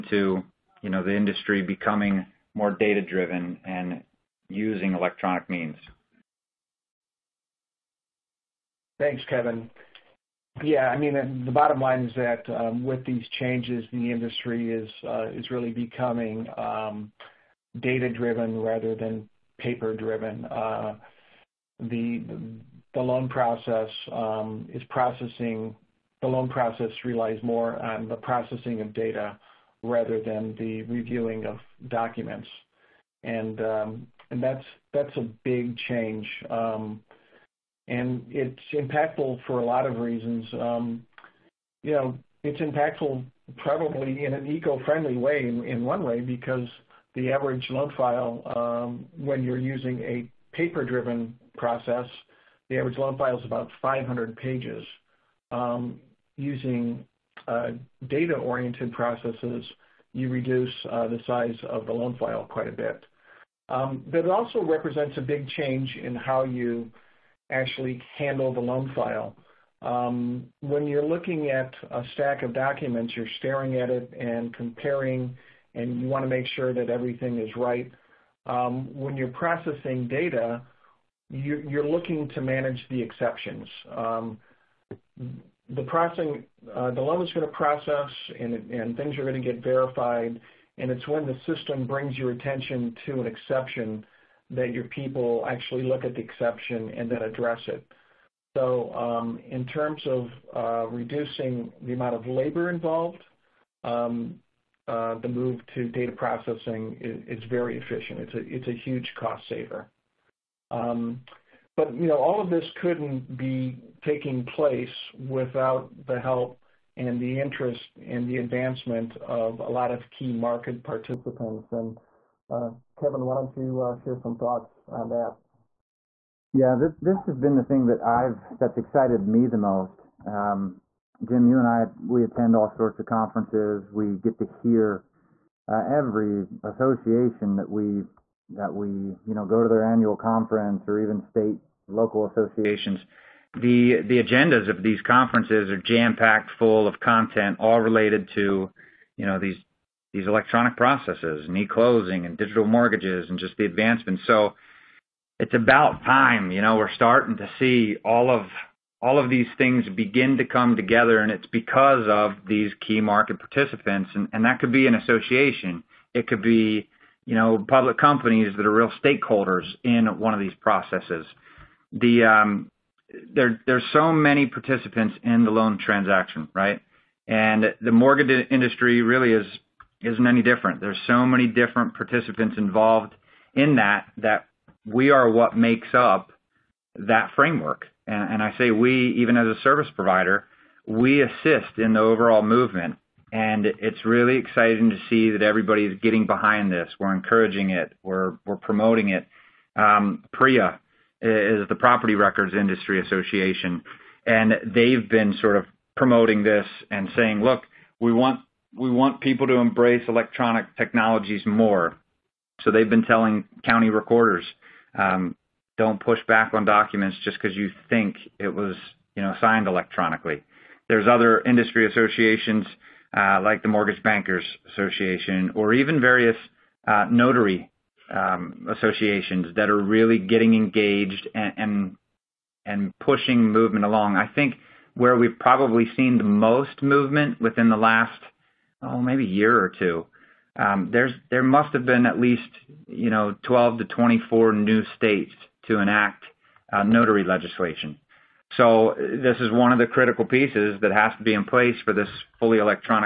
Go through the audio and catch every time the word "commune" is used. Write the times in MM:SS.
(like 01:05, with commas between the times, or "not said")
not said.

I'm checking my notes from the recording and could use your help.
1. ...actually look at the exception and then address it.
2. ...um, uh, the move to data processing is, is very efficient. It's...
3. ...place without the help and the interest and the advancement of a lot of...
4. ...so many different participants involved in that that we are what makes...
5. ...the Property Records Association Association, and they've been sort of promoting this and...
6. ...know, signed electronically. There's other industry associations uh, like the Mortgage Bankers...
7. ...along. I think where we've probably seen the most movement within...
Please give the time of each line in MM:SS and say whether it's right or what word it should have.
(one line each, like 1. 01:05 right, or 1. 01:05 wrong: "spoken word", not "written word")
1. 01:35 right
2. 01:43 right
3. 01:54 right
4. 03:01 right
5. 03:21 wrong: "Industry", not "Association"
6. 03:39 right
7. 03:53 right.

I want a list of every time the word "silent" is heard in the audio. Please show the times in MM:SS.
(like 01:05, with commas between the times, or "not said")
not said.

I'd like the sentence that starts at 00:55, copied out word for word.
Um, using uh, data-oriented processes, you reduce uh, the size of the loan file quite a bit.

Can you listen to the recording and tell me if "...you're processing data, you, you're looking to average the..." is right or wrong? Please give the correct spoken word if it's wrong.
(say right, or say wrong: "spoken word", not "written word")
wrong: "manage", not "average".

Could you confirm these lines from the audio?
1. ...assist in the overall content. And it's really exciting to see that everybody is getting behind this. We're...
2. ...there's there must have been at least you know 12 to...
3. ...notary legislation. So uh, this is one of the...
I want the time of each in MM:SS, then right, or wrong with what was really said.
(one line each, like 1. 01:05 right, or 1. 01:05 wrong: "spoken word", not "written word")
1. 03:11 wrong: "movement", not "content"
2. 04:00 right
3. 04:06 right.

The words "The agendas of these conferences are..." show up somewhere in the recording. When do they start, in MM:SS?
02:23.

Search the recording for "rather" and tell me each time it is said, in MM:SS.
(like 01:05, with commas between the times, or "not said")
00:18, 00:29.